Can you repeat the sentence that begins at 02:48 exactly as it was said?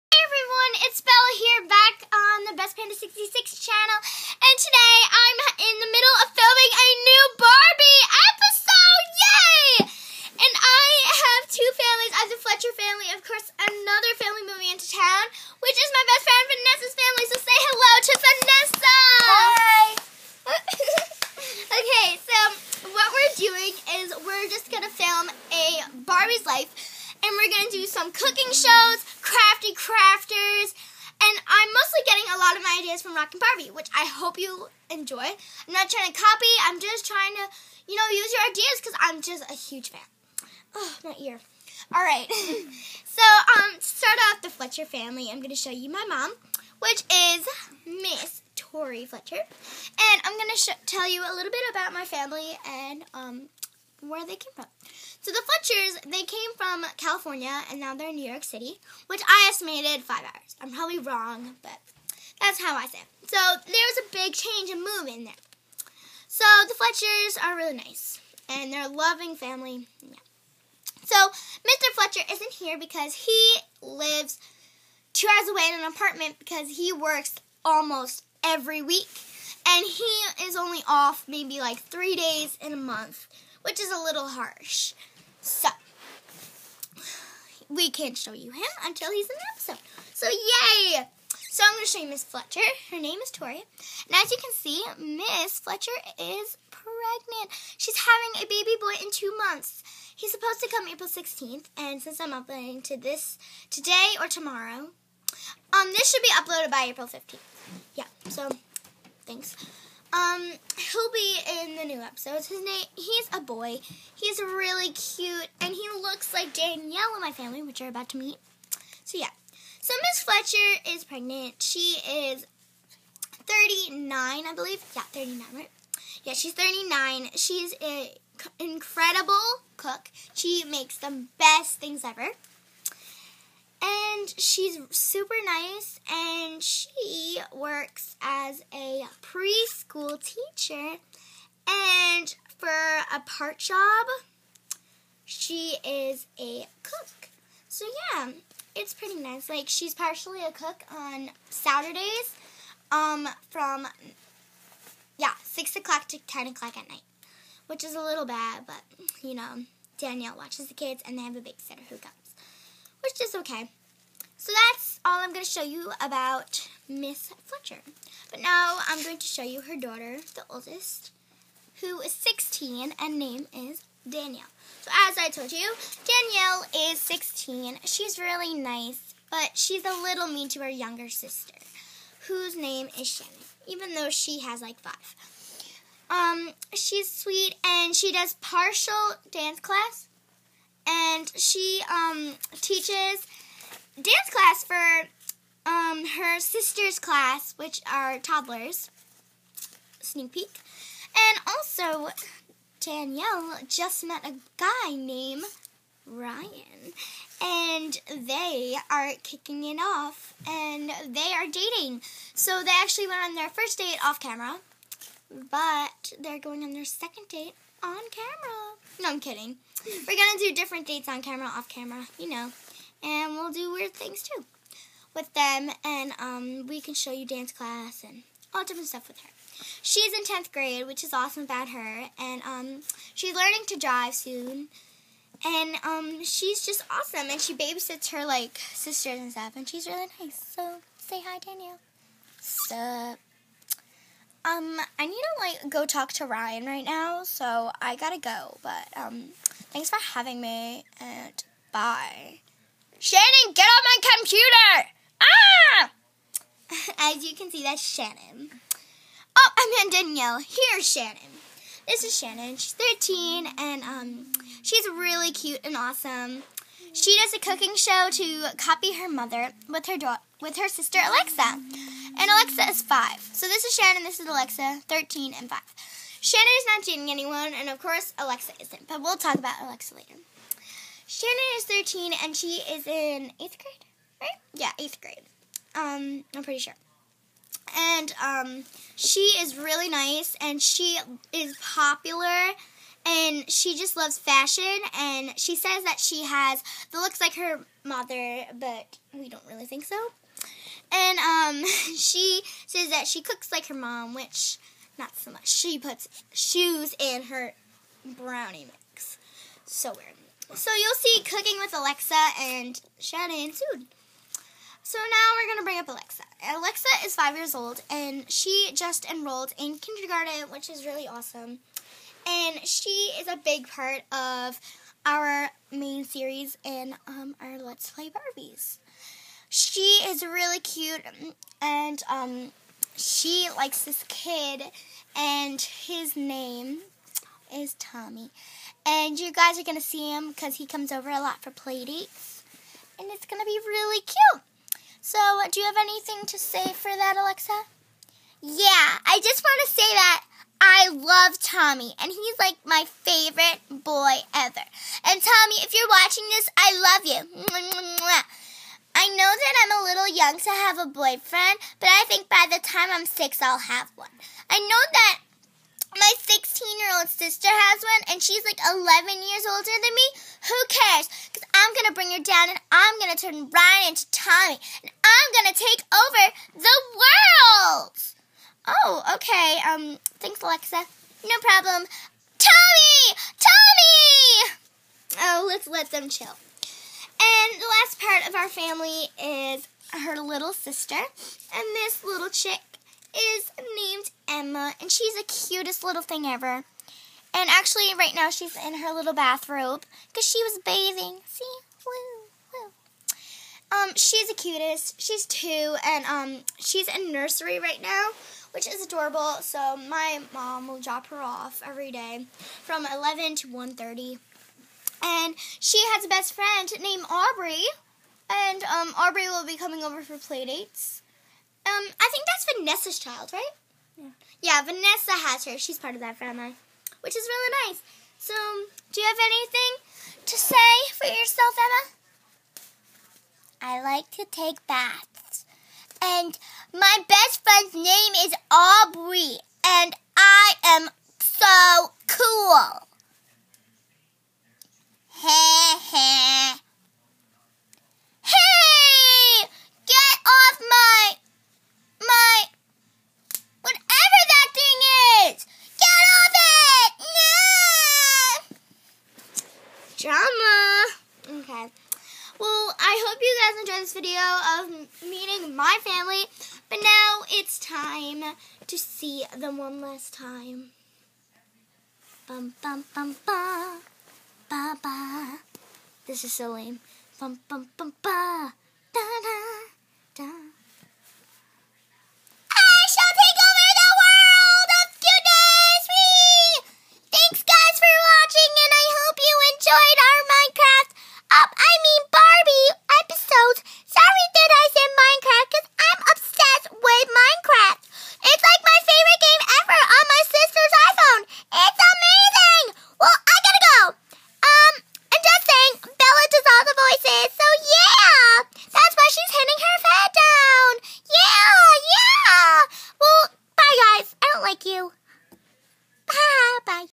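But now I'm going to show you her daughter, the oldest, who is 16 and name is Danielle.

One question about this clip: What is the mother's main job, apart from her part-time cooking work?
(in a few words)
Preschool teacher.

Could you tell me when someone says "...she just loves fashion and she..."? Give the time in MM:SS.
04:53.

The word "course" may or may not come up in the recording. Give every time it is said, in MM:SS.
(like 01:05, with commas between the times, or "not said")
00:13, 04:37.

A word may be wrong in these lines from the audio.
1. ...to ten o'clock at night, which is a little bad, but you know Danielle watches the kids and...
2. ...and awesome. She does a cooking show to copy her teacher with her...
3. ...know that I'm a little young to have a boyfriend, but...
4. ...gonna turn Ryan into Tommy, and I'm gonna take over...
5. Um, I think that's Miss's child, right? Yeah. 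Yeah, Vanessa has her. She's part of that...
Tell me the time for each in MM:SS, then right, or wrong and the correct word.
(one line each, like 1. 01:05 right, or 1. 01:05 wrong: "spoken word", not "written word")
1. 02:36 right
2. 04:25 wrong: "mother", not "teacher"
3. 05:59 right
4. 06:12 right
5. 07:01 wrong: "Vanessa", not "Miss".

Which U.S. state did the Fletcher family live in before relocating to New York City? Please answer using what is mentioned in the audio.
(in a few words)
California.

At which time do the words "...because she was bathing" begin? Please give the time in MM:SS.
06:40.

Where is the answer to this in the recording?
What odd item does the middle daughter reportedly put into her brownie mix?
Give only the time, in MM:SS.
05:06.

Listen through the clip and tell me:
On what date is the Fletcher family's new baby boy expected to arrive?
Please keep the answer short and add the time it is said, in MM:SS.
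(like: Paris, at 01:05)
April 16th, at 01:40.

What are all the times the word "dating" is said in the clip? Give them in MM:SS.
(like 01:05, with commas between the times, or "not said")
03:31, 04:36.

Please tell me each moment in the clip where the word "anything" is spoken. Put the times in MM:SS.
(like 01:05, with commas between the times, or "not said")
05:45, 07:09.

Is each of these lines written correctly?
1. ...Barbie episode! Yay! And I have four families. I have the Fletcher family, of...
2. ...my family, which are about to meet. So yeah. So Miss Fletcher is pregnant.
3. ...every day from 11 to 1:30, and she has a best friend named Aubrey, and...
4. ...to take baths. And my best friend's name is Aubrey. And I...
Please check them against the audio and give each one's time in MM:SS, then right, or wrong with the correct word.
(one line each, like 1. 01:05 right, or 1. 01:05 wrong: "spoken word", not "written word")
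1. 00:07 wrong: "two", not "four"
2. 01:57 right
3. 06:51 right
4. 07:14 right.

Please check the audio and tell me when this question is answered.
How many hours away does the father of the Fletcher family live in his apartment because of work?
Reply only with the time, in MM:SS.
01:15.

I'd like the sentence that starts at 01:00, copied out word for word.
I'm probably wrong, but that's how I say it.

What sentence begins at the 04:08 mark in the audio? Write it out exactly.
But um, thanks for having me, and bye.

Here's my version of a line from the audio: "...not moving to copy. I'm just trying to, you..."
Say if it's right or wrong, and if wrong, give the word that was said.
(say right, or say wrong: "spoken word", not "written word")
wrong: "trying", not "moving".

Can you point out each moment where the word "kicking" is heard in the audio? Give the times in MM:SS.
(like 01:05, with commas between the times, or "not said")
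03:29.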